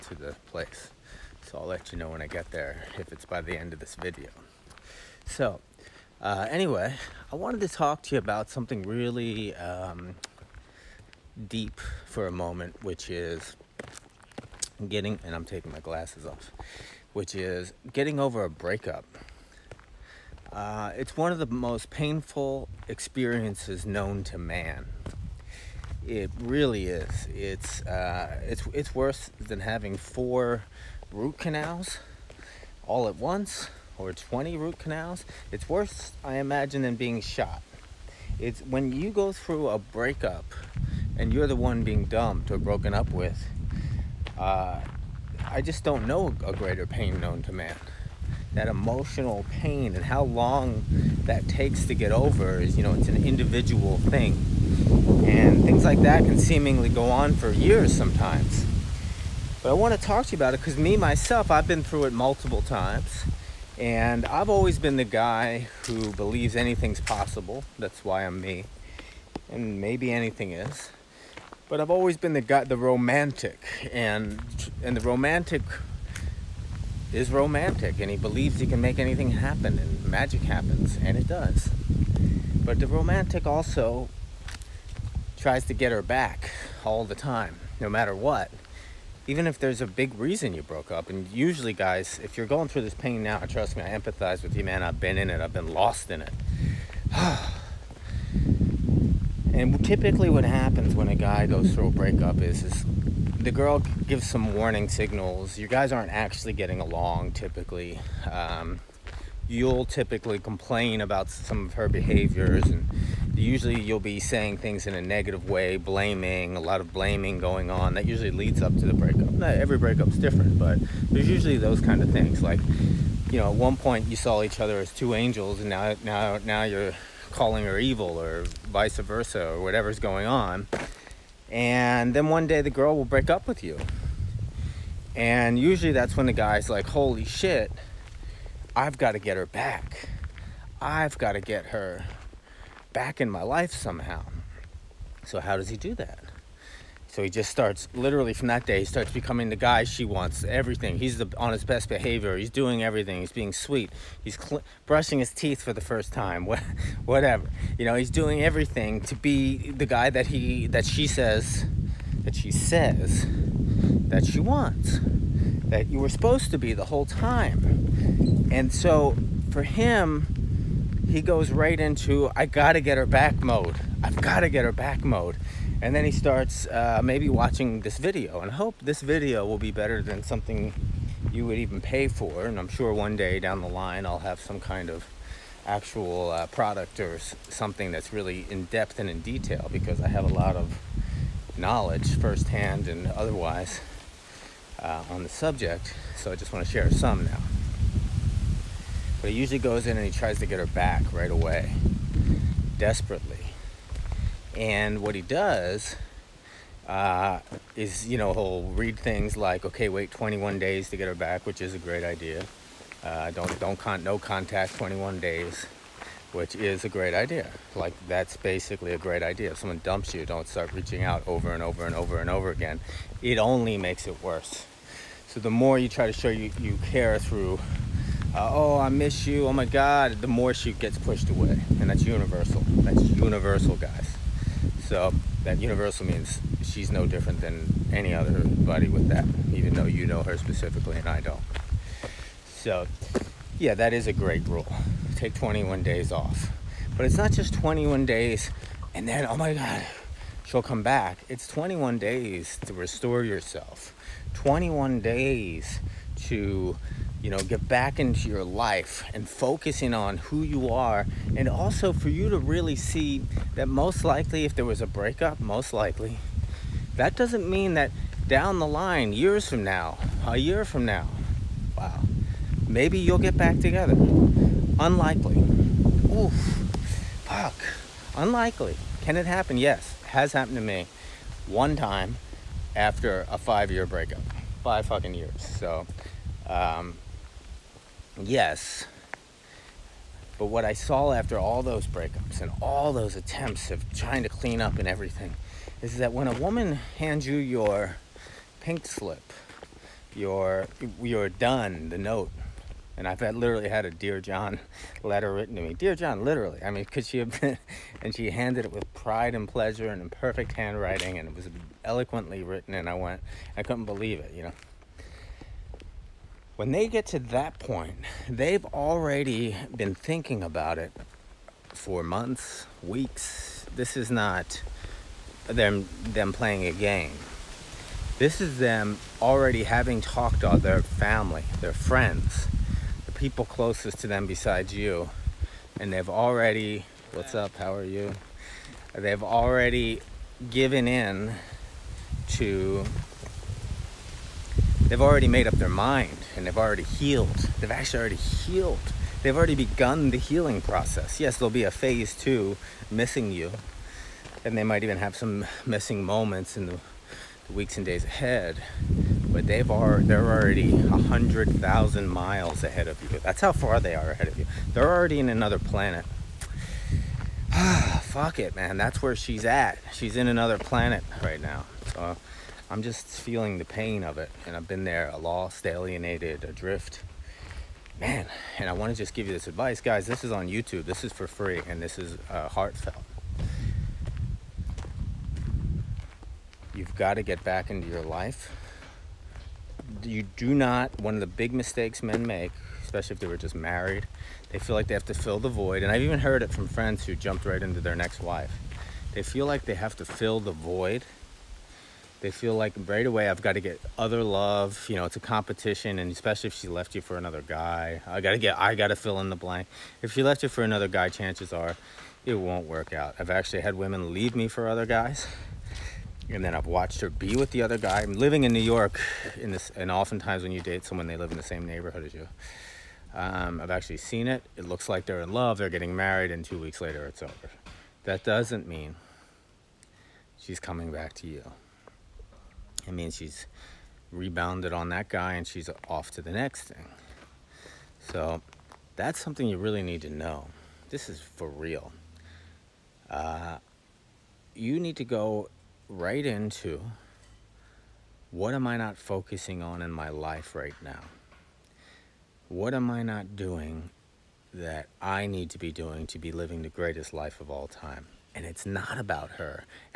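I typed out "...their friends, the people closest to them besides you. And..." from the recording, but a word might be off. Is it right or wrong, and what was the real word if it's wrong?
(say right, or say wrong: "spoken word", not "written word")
right.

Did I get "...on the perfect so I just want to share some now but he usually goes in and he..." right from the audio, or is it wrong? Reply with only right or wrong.
wrong.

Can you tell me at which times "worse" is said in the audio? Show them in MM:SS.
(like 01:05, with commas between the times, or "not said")
00:28, 00:35, 03:44.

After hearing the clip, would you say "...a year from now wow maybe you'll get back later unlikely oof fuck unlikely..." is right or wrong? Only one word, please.
wrong.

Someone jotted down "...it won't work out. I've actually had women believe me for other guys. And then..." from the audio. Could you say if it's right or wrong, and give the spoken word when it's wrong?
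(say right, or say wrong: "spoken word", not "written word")
wrong: "leave", not "believe".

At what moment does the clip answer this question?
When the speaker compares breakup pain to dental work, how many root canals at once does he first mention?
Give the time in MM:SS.
00:29.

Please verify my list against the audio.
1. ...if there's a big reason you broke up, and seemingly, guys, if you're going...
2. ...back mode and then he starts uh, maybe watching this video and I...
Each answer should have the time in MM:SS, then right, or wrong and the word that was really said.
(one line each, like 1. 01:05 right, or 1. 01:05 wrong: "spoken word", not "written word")
1. 01:29 wrong: "usually", not "seemingly"
2. 02:54 right.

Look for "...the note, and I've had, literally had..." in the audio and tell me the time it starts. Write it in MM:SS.
05:01.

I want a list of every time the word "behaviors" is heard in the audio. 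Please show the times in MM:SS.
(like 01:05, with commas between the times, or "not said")
01:51, 02:31.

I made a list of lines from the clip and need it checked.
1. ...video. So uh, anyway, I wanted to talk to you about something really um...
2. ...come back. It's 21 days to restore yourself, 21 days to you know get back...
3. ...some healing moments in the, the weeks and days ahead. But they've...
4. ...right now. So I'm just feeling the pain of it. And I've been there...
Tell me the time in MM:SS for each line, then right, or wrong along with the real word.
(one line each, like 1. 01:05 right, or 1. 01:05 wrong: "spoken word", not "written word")
1. 00:03 right
2. 04:10 right
3. 05:55 wrong: "missing", not "healing"
4. 06:11 right.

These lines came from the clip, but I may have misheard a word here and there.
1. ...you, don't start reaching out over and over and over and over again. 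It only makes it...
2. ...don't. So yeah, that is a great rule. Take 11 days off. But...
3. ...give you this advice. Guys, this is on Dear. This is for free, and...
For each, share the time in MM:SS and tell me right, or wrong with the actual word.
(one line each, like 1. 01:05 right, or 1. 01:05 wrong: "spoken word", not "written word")
1. 03:40 right
2. 04:01 wrong: "21", not "11"
3. 06:19 wrong: "YouTube", not "Dear".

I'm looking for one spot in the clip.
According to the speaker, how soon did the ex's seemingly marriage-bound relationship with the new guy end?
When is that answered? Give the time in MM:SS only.
07:06.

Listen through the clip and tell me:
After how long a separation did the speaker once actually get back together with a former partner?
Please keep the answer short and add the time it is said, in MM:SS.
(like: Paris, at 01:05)
5 years, at 04:43.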